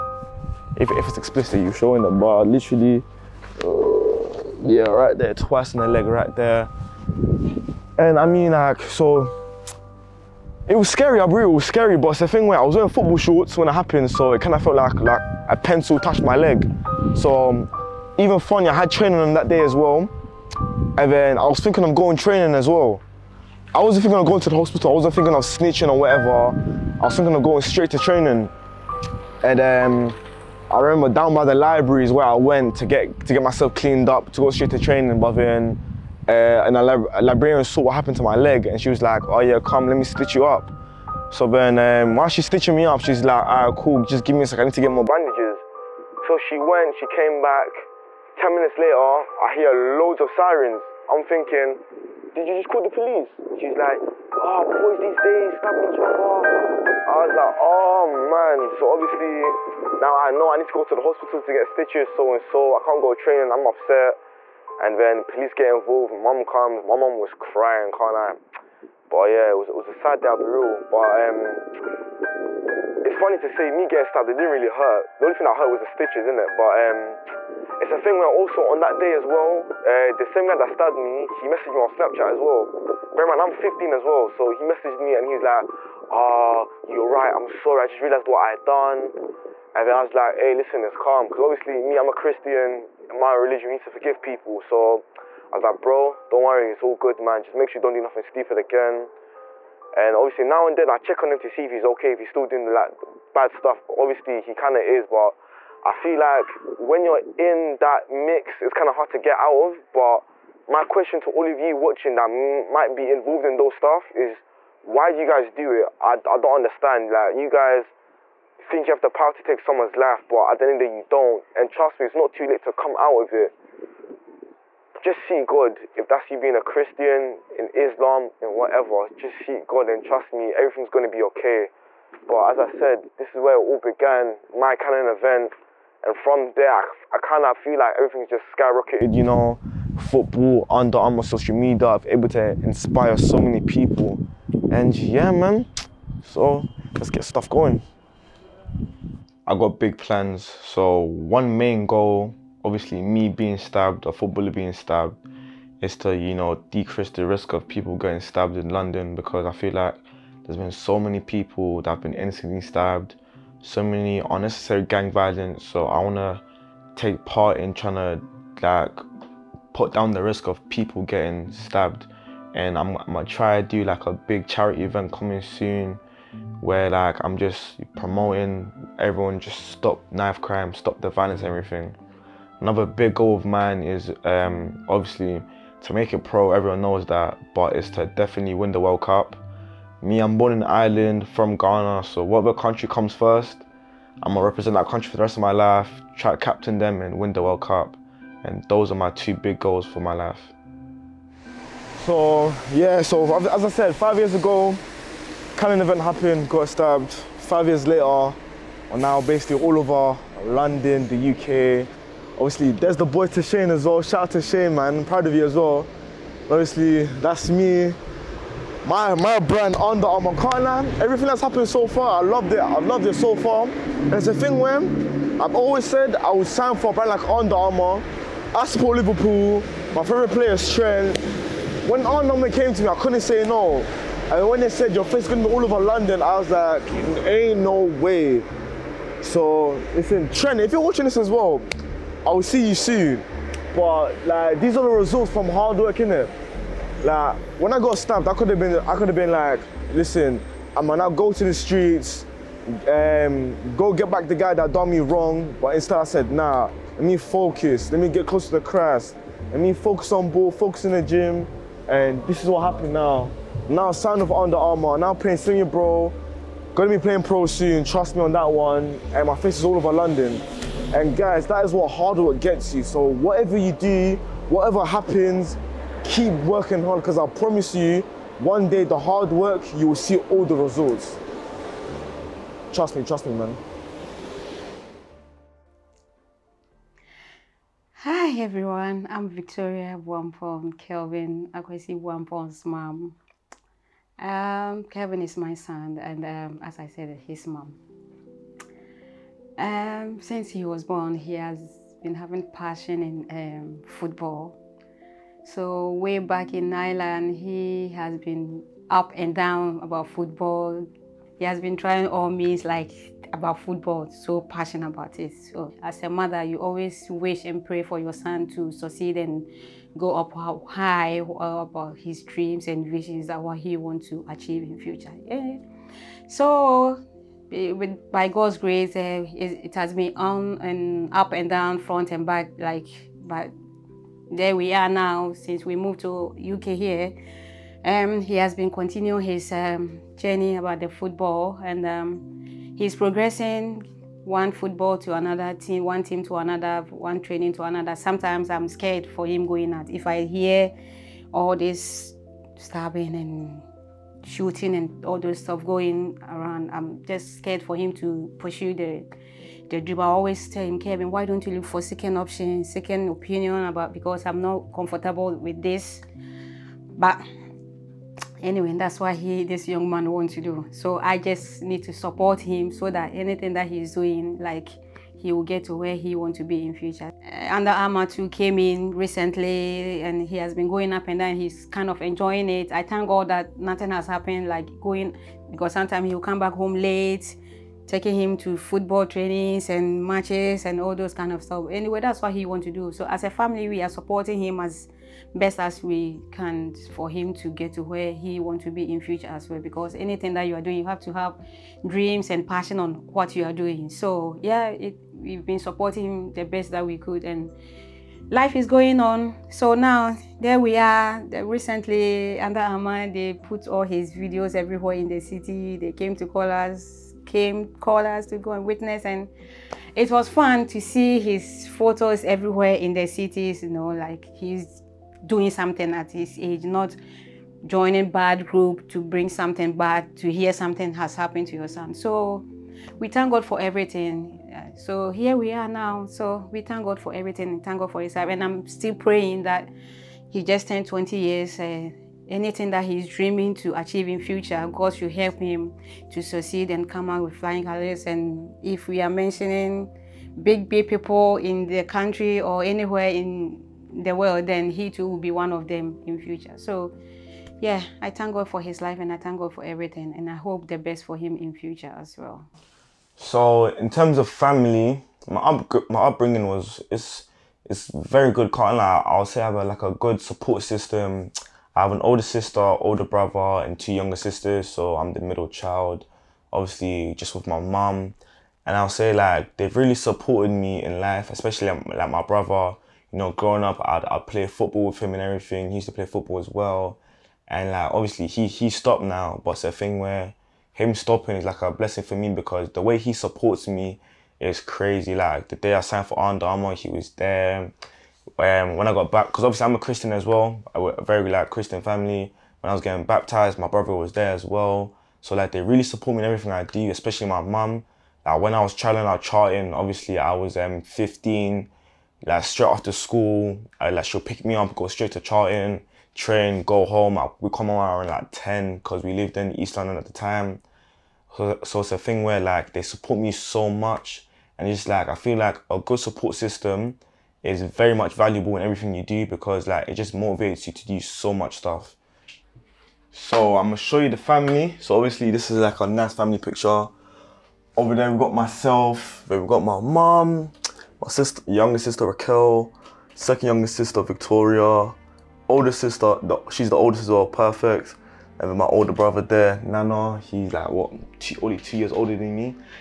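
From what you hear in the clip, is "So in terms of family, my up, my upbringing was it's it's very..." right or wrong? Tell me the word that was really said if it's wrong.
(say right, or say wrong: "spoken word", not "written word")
right.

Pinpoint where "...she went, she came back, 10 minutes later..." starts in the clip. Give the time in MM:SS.
00:46.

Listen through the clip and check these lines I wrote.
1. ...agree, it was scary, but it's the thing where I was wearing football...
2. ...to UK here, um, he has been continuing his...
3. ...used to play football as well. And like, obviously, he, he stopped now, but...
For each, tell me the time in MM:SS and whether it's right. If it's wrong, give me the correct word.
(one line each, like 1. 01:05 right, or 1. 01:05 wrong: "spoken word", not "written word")
1. 00:11 right
2. 05:36 right
3. 08:05 right.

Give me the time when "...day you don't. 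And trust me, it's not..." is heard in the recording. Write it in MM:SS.
02:00.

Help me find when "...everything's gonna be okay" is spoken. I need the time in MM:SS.
02:10.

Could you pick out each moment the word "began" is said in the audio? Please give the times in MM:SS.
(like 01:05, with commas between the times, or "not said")
02:13.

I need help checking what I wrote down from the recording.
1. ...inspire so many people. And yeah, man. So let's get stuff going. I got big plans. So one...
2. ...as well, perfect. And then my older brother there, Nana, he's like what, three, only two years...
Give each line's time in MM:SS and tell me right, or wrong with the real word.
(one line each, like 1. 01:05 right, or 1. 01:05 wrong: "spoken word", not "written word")
1. 02:22 right
2. 09:07 wrong: "two", not "three".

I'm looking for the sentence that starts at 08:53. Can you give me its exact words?
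So I'm gonna show you the family.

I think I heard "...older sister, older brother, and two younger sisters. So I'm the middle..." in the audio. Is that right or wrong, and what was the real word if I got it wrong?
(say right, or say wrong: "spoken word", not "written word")
right.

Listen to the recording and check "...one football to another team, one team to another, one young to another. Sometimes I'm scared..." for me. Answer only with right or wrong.
wrong.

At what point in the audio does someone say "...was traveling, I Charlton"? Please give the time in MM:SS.
08:28.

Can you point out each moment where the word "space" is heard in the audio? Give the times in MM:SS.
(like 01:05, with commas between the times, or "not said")
not said.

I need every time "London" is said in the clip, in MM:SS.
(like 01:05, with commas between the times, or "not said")
02:38, 03:30, 03:55, 04:29, 08:39.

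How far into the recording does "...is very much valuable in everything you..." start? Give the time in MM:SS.
08:47.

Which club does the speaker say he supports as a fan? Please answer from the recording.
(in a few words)
Liverpool.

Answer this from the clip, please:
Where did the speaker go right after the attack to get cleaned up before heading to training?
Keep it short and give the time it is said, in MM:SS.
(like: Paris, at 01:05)
The library, at 00:31.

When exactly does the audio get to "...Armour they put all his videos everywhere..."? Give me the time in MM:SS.
06:52.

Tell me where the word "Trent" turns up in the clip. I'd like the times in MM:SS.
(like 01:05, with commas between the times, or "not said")
03:50, 04:00.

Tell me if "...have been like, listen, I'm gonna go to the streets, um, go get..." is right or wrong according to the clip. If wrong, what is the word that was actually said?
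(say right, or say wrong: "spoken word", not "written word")
right.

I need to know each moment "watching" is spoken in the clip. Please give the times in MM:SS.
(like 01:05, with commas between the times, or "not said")
01:51, 04:00.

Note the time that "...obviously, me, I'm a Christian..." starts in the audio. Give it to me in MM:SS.
01:31.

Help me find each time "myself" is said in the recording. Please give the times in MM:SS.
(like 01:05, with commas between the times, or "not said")
00:33, 08:58.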